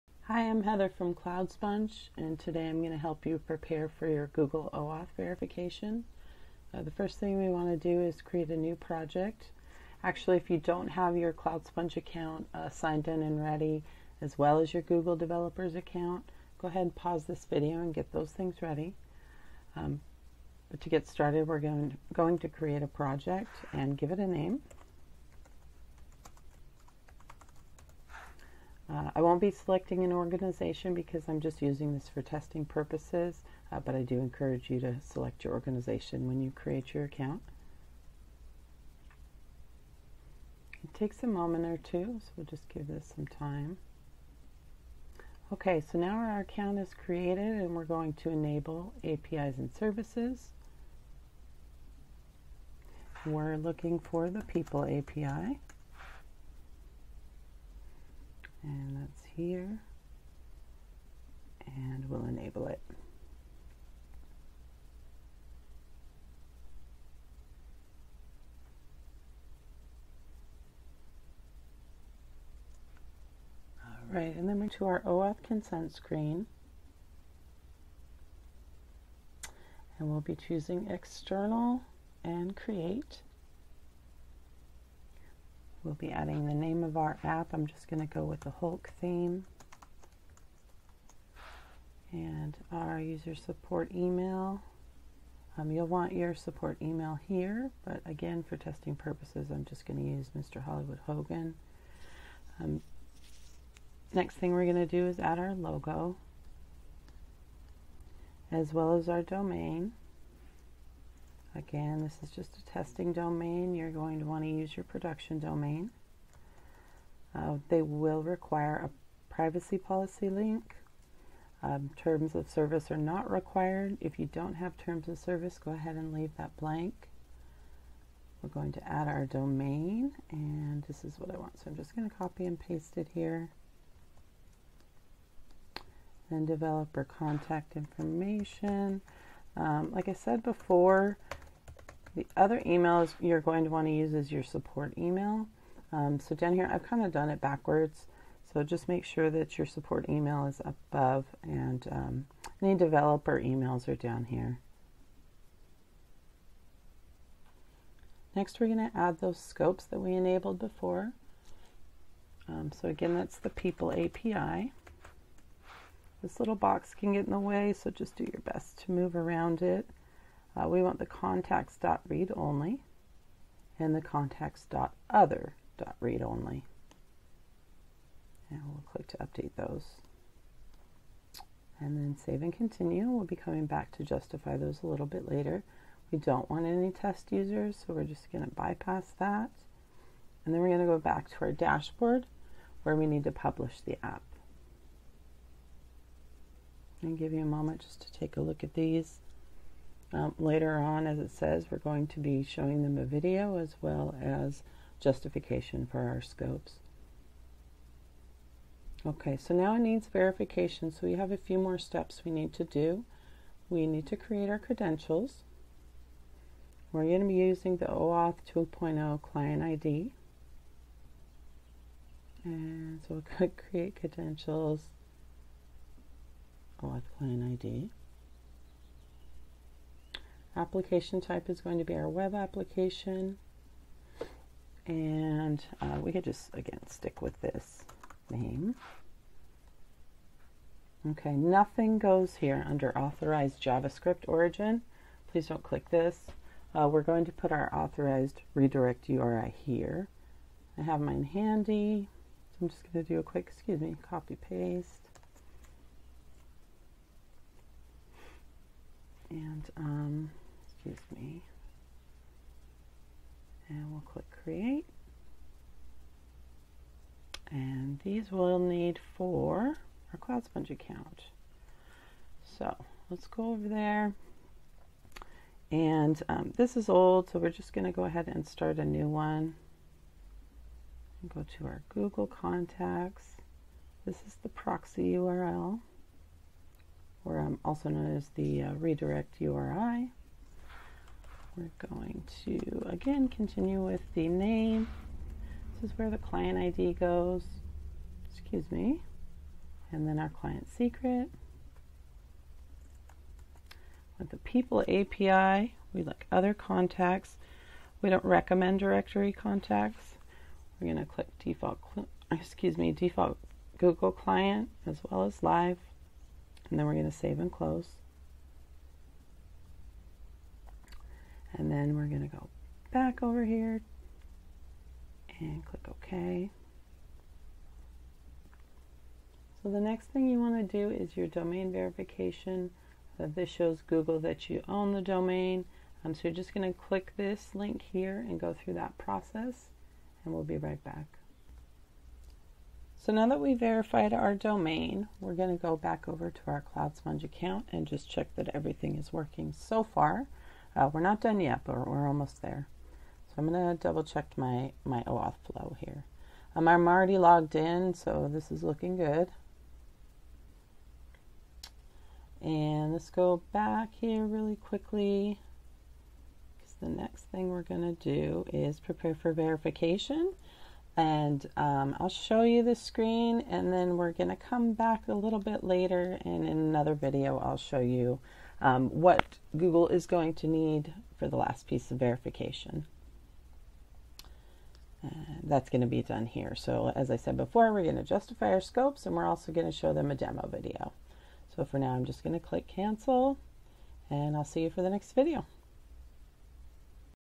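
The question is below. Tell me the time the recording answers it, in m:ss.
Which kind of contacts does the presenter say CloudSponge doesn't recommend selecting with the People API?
5:08.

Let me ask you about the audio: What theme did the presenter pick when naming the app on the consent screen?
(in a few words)
Hulk.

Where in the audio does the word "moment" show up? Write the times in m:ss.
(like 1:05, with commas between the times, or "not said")
0:41, 3:17.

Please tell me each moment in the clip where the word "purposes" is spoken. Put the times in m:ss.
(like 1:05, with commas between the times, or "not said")
0:32, 1:38.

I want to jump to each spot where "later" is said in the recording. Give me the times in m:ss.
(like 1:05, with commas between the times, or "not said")
3:05, 3:20, 6:15.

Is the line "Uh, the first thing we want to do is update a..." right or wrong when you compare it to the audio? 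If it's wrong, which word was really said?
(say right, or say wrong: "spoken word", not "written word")
wrong: "create", not "update".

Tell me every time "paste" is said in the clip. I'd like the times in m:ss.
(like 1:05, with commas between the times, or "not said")
2:12, 4:14.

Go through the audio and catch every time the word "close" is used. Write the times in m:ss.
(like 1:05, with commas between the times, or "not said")
5:17.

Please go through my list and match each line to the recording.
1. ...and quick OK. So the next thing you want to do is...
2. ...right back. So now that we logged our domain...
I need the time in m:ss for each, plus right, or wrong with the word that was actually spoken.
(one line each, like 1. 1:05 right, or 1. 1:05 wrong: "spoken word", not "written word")
1. 5:25 wrong: "click", not "quick"
2. 5:40 wrong: "verified", not "logged".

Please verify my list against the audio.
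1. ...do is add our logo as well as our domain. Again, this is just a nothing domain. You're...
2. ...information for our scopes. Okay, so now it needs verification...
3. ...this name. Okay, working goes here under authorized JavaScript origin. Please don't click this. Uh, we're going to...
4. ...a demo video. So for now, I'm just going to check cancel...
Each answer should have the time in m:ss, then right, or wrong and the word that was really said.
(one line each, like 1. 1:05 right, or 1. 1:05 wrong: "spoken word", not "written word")
1. 1:44 wrong: "testing", not "nothing"
2. 3:24 wrong: "justification", not "information"
3. 3:57 wrong: "nothing", not "working"
4. 6:30 wrong: "click", not "check".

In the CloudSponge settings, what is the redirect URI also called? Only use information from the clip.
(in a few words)
proxy URL.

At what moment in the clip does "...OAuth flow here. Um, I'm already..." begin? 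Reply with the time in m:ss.
5:55.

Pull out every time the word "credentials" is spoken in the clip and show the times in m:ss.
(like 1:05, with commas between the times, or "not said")
3:34, 3:43.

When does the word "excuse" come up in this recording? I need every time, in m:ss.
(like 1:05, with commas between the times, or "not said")
4:13, 4:58, 5:12.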